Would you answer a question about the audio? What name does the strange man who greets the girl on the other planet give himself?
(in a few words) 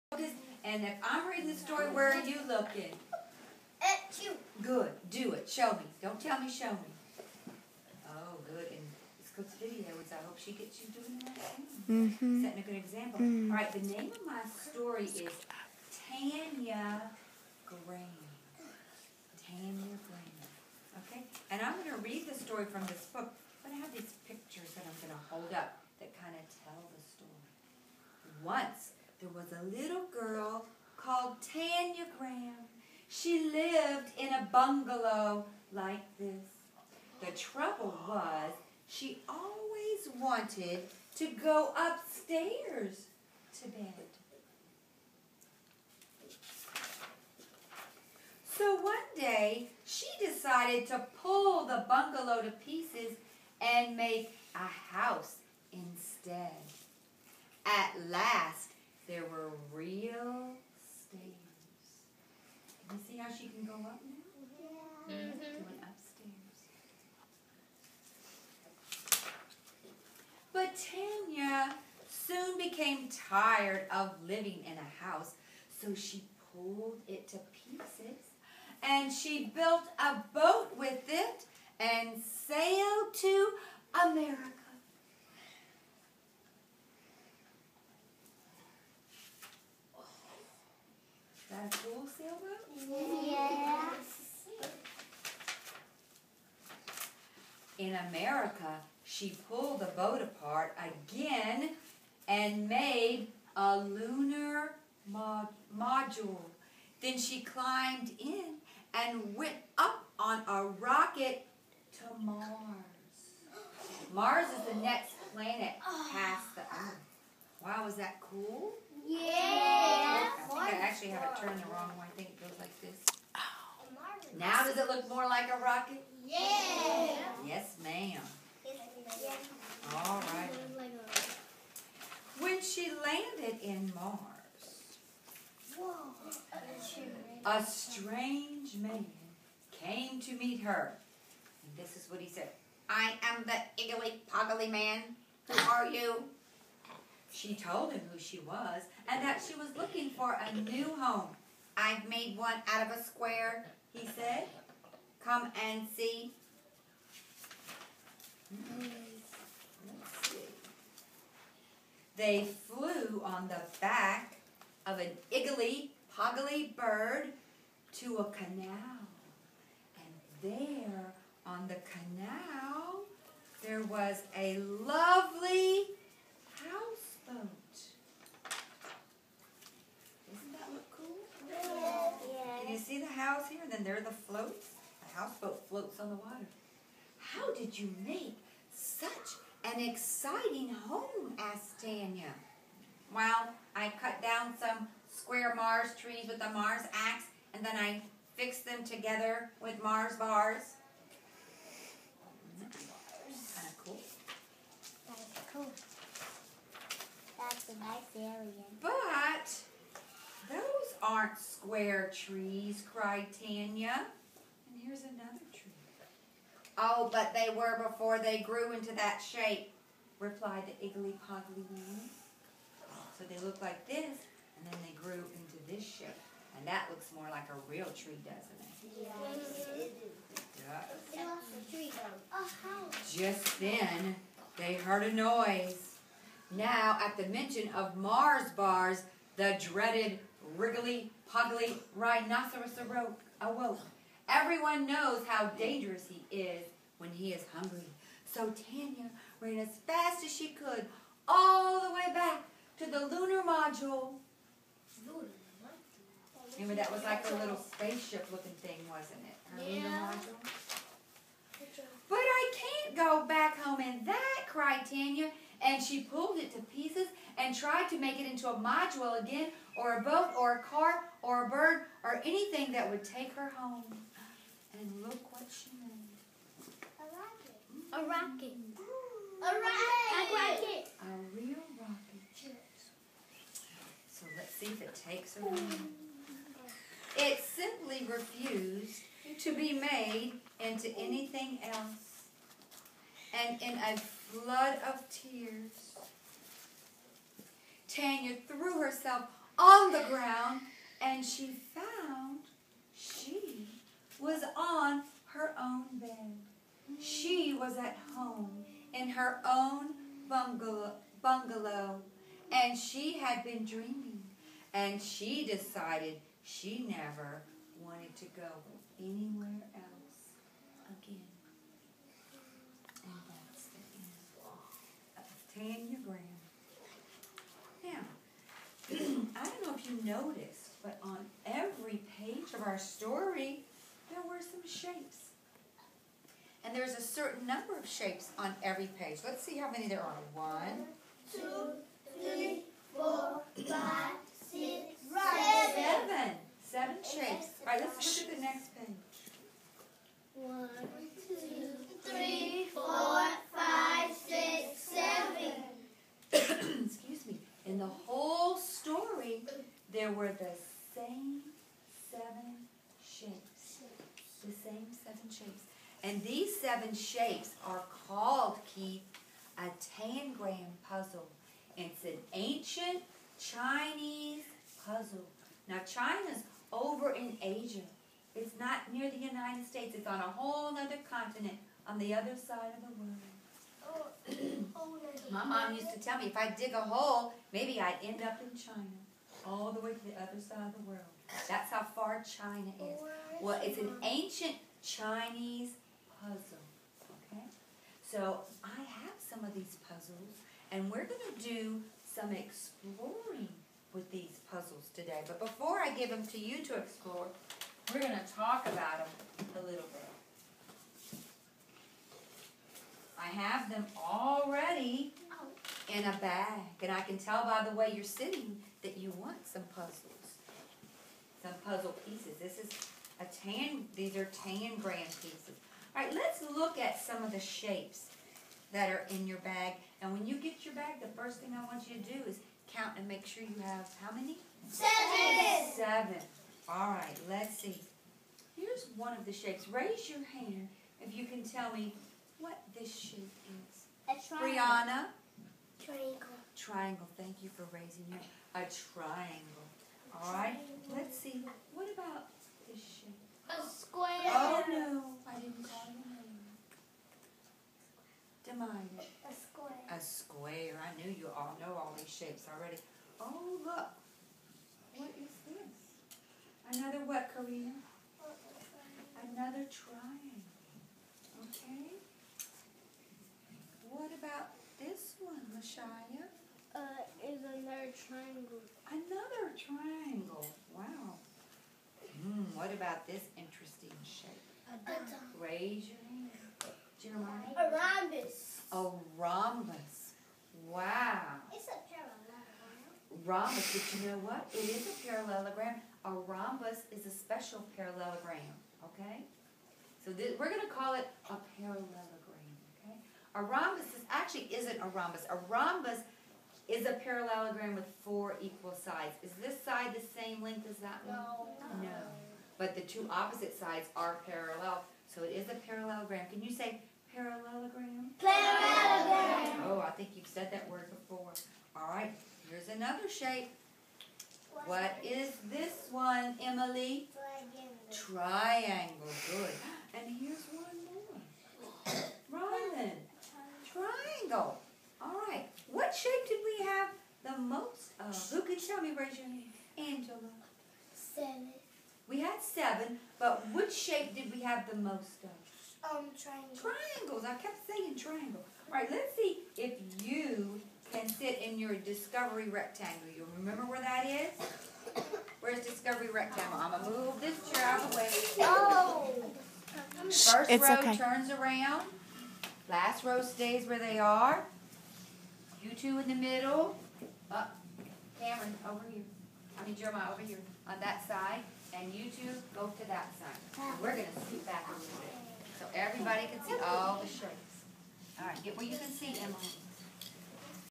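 Iggly Poggly Man.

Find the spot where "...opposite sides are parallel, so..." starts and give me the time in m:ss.
8:33.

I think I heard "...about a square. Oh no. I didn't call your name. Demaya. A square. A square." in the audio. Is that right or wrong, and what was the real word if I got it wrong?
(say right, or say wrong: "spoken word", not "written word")
right.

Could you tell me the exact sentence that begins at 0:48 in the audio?
So one day, she decided to pull the bungalow to pieces and make a house instead.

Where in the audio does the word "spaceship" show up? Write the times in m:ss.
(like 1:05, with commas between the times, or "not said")
4:17.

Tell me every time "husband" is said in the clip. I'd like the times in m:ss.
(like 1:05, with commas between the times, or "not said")
not said.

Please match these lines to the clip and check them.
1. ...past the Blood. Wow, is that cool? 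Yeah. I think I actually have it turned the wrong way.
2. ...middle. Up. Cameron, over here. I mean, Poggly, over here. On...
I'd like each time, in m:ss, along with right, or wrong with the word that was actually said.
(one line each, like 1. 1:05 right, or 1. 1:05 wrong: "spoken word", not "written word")
1. 1:56 wrong: "Earth", not "Blood"
2. 9:26 wrong: "Jeremiah", not "Poggly".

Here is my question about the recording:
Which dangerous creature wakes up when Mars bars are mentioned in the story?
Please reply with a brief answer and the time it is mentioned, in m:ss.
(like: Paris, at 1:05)
Wriggly Poggly Rhinoceros, at 4:00.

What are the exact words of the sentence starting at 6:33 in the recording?
Oh, well, it's an ancient Chinese puzzle, okay?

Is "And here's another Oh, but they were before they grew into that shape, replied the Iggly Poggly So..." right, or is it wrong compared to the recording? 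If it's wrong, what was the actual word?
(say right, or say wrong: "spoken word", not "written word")
right.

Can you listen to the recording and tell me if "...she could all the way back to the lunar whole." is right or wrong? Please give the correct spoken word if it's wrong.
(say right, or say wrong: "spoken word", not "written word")
wrong: "module", not "whole".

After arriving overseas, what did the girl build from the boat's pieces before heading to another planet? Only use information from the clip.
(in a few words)
lunar module.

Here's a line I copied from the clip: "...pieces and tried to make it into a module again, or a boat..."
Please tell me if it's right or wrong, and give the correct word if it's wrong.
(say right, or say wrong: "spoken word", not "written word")
right.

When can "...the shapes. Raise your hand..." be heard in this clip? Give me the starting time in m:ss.
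7:19.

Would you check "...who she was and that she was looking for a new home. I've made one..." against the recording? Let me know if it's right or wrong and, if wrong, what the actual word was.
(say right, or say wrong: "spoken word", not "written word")
right.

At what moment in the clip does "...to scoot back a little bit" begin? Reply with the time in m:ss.
9:34.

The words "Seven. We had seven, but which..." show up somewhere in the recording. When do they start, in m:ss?
9:00.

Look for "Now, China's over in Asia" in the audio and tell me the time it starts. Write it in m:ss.
6:15.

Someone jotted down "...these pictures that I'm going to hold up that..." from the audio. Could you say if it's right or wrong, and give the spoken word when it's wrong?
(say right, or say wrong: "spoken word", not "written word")
right.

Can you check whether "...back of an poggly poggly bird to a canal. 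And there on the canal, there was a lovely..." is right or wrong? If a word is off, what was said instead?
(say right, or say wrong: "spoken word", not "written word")
wrong: "iggly", not "poggly".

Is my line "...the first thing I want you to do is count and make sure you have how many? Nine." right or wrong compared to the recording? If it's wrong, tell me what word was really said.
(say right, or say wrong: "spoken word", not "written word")
wrong: "Seven", not "Nine".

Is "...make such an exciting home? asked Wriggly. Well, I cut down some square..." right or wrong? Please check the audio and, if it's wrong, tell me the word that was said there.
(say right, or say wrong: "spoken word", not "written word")
wrong: "Tanya", not "Wriggly".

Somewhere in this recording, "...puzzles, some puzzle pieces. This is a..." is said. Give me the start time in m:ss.
6:59.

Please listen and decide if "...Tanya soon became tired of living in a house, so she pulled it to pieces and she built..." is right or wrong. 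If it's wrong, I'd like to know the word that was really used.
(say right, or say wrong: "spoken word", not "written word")
right.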